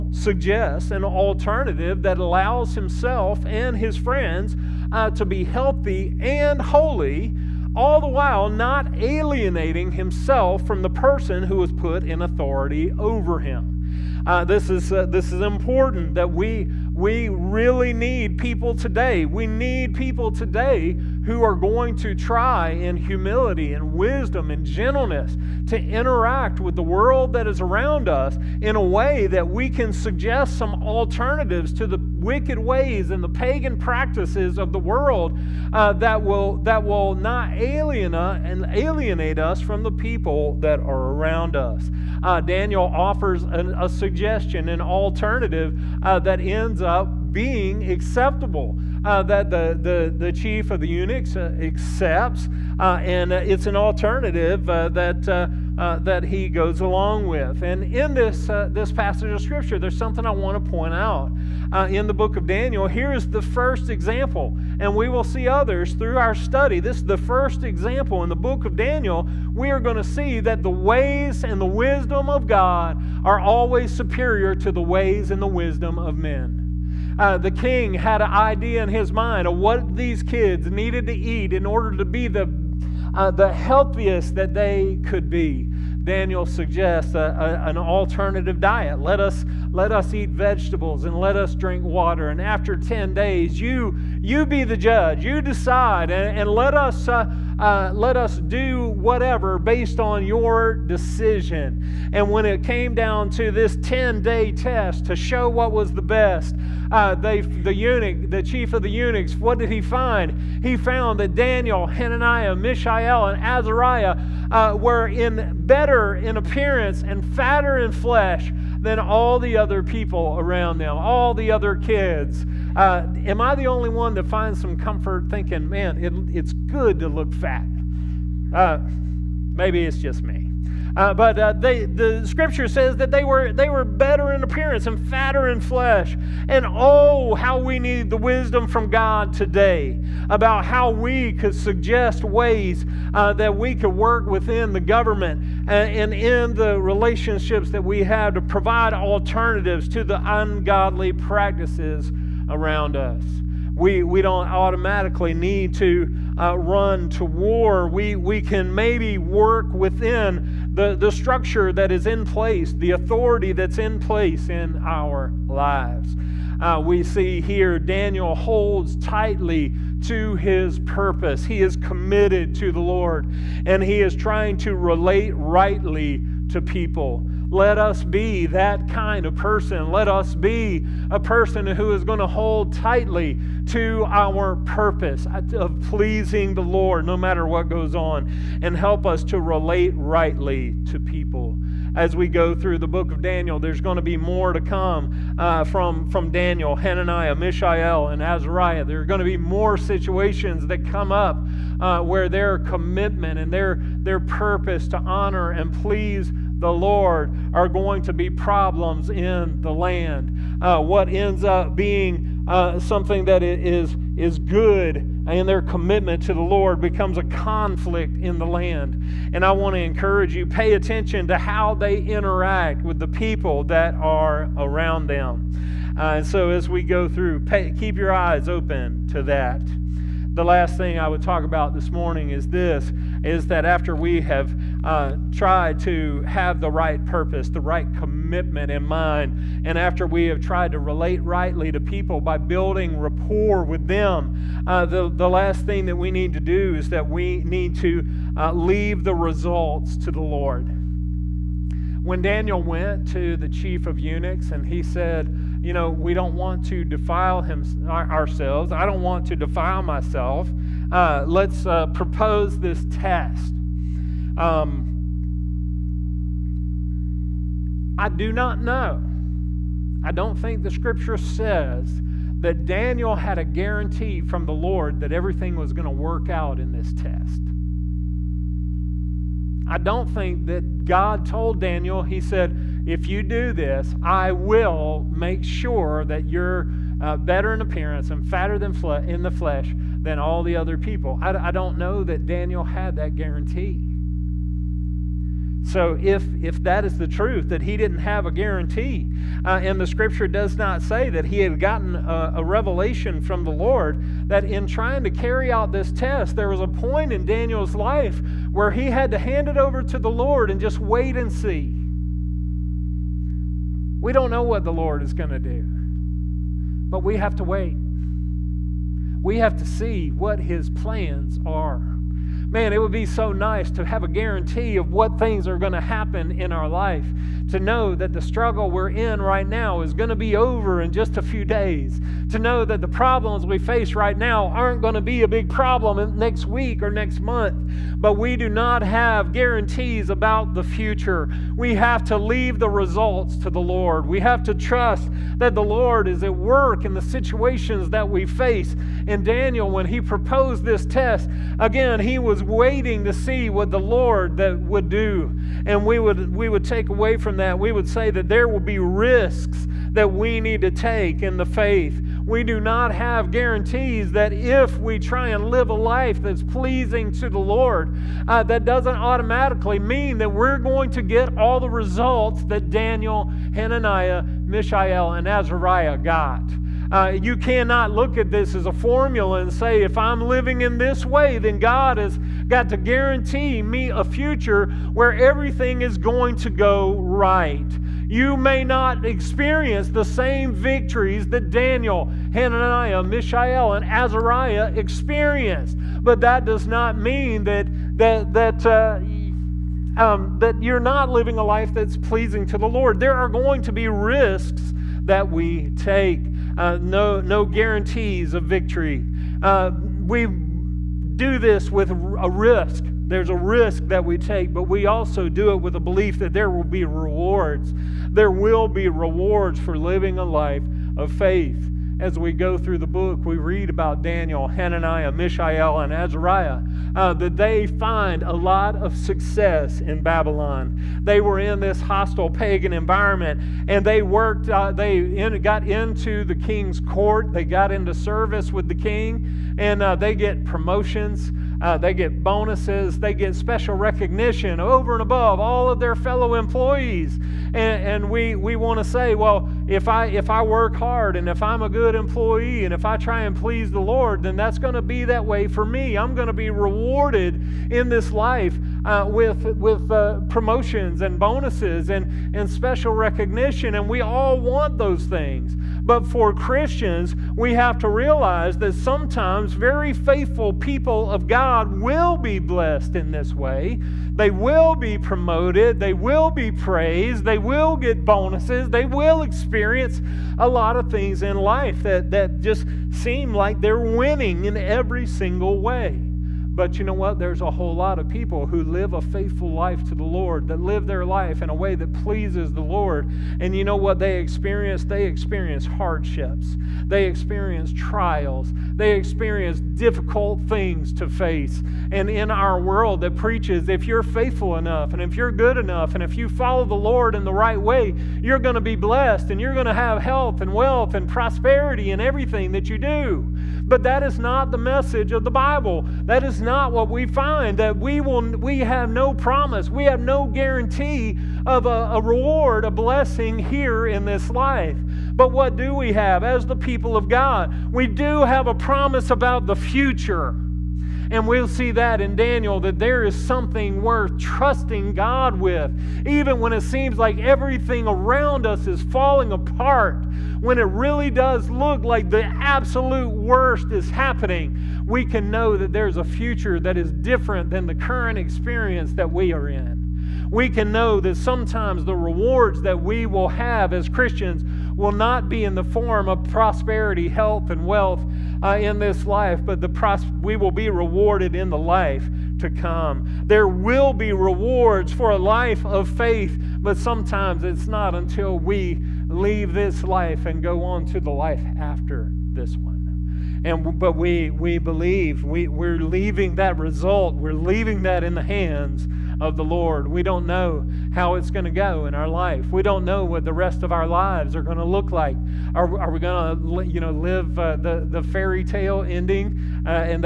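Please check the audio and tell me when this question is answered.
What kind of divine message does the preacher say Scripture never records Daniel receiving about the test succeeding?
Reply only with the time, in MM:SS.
05:02.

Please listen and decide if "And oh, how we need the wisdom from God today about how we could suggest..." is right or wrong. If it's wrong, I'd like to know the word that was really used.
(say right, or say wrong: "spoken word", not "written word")
right.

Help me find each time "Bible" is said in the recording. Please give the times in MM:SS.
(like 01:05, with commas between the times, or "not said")
08:35.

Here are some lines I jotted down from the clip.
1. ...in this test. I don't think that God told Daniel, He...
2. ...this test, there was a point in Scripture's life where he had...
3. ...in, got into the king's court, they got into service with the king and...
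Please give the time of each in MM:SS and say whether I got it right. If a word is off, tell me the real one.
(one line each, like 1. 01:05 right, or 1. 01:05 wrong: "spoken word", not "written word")
1. 04:36 right
2. 05:05 wrong: "Daniel", not "Scripture"
3. 07:15 right.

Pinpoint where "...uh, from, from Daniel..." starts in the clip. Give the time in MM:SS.
03:15.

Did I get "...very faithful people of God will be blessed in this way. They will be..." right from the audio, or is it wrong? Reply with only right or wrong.
right.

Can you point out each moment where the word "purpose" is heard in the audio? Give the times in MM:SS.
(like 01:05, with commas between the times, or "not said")
02:50, 03:04, 03:24, 03:57.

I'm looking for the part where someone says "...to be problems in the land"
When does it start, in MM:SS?
03:28.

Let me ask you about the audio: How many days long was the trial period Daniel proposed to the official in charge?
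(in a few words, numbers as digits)
10.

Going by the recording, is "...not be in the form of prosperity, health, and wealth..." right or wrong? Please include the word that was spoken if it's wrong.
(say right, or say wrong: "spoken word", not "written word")
right.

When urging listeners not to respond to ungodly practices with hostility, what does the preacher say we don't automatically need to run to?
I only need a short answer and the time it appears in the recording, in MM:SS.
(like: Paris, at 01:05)
War, at 02:37.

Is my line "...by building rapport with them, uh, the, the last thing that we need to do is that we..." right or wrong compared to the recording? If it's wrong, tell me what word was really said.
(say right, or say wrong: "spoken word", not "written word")
right.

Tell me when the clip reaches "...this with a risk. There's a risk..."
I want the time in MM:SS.
06:51.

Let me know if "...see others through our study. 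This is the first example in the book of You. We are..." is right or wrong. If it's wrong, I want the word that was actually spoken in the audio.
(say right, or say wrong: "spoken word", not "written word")
wrong: "Daniel", not "You".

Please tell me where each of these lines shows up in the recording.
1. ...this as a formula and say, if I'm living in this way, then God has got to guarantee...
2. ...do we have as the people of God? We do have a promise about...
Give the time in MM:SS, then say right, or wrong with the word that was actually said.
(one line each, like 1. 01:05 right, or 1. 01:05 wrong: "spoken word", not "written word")
1. 06:18 right
2. 08:45 right.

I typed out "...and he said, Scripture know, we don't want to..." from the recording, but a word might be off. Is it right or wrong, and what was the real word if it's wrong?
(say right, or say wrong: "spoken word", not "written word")
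wrong: "You", not "Scripture".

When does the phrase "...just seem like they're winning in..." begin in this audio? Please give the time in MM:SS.
08:02.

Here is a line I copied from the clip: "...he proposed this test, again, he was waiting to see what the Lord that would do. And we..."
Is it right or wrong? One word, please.
right.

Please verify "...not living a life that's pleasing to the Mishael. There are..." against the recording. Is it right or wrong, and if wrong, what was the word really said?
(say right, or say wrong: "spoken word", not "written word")
wrong: "Lord", not "Mishael".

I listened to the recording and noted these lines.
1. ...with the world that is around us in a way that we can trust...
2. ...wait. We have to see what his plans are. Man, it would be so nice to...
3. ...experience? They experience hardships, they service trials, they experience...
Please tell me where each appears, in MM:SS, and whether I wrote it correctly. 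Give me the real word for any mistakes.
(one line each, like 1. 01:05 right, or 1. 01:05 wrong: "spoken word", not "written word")
1. 00:26 wrong: "suggest", not "trust"
2. 05:17 right
3. 08:14 wrong: "experience", not "service".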